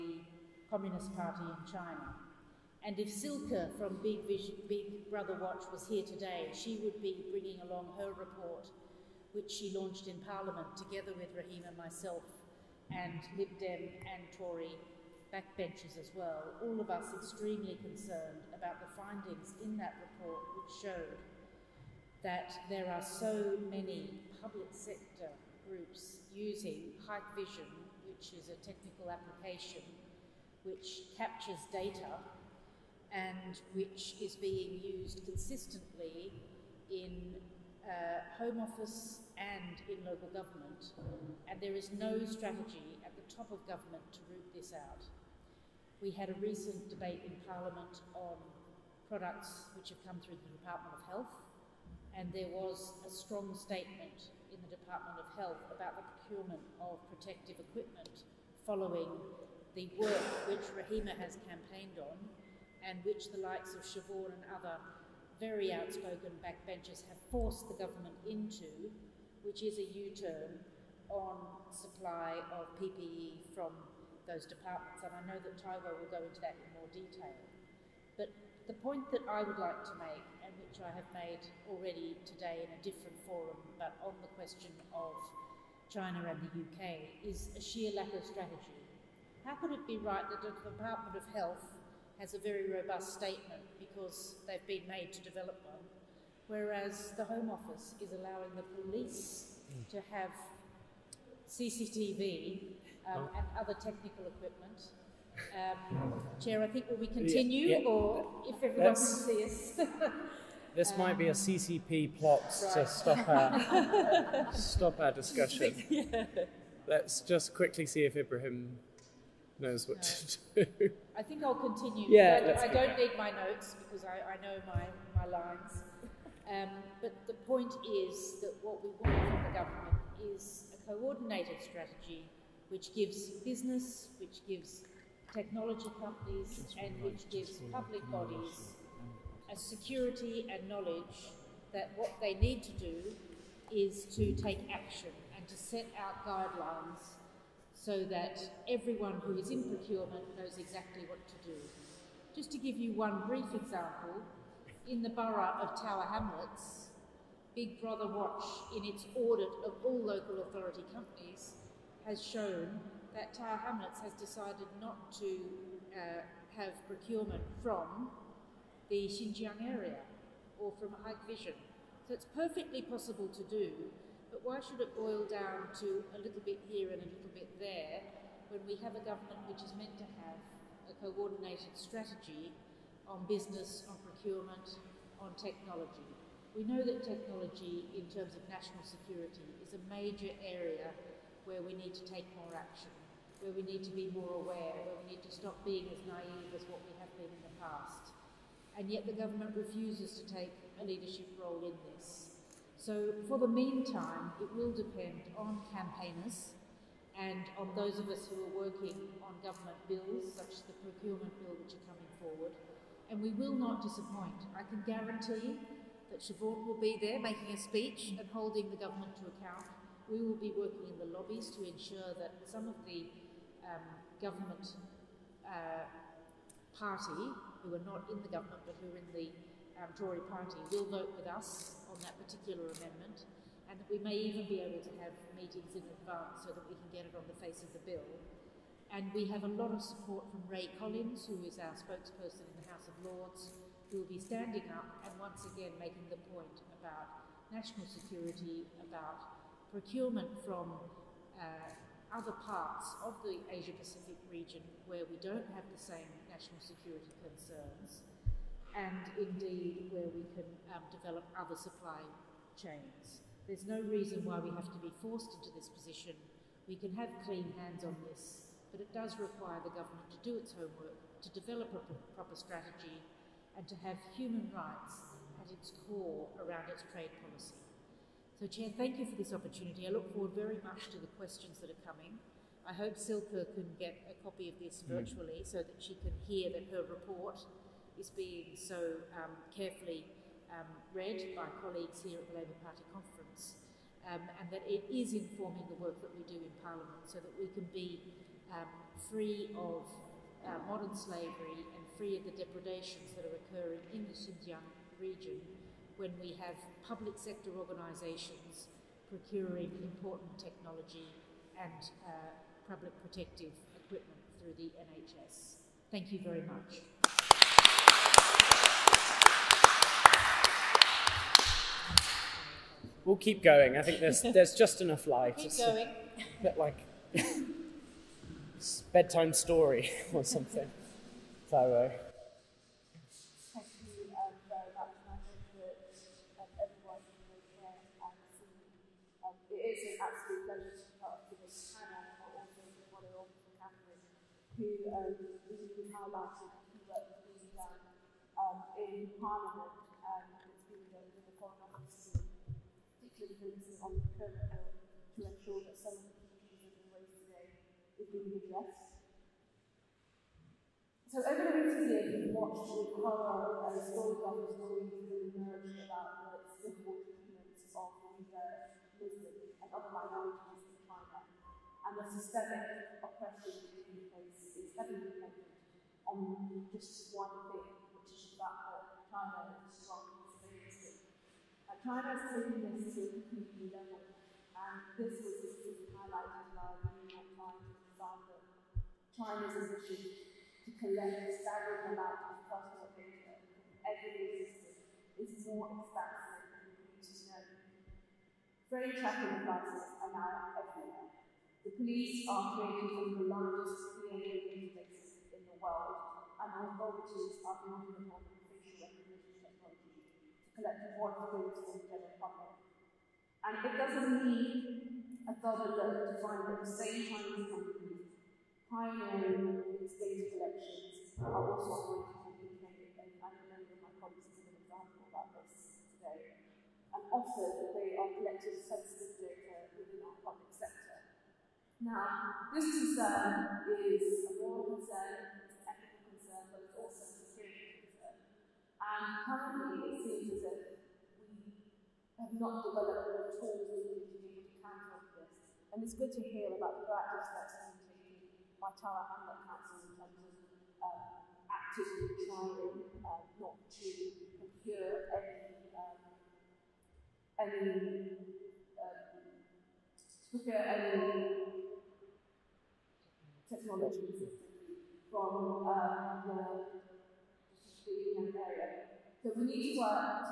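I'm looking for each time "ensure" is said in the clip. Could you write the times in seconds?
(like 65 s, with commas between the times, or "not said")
221 s, 355 s.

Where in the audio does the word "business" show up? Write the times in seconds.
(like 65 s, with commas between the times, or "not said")
133 s, 183 s.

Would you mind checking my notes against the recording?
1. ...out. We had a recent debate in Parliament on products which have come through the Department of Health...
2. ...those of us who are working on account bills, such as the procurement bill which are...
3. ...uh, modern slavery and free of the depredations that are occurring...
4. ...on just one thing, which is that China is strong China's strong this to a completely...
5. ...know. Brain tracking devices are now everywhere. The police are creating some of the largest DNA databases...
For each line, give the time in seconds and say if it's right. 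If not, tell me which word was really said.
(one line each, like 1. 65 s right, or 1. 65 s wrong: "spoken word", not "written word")
1. 44 s right
2. 207 s wrong: "government", not "account"
3. 300 s right
4. 376 s wrong: "taking", not "strong"
5. 397 s right.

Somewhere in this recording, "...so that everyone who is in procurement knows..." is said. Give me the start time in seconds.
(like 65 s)
147 s.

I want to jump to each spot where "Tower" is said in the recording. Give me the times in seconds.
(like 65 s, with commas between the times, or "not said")
155 s, 163 s, 448 s.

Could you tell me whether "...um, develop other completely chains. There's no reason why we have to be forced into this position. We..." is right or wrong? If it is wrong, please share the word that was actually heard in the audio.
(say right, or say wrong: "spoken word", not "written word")
wrong: "supply", not "completely".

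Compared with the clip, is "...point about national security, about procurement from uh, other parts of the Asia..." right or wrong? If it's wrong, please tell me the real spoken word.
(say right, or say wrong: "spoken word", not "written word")
right.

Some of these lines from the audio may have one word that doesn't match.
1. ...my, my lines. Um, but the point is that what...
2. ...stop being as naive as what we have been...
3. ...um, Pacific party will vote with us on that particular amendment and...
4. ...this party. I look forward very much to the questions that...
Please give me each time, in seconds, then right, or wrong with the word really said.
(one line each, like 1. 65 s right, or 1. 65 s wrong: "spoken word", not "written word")
1. 124 s right
2. 195 s right
3. 229 s wrong: "Tory", not "Pacific"
4. 279 s wrong: "opportunity", not "party".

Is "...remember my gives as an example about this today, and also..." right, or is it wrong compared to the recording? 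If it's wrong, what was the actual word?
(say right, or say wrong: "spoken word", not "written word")
wrong: "colleagues", not "gives".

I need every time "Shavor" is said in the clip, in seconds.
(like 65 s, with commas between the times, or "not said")
63 s.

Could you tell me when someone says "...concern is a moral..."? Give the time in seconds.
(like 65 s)
432 s.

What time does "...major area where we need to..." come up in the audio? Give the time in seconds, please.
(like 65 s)
189 s.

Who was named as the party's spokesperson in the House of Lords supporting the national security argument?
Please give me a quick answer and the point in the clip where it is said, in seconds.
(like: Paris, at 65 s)
Ray Collins, at 240 s.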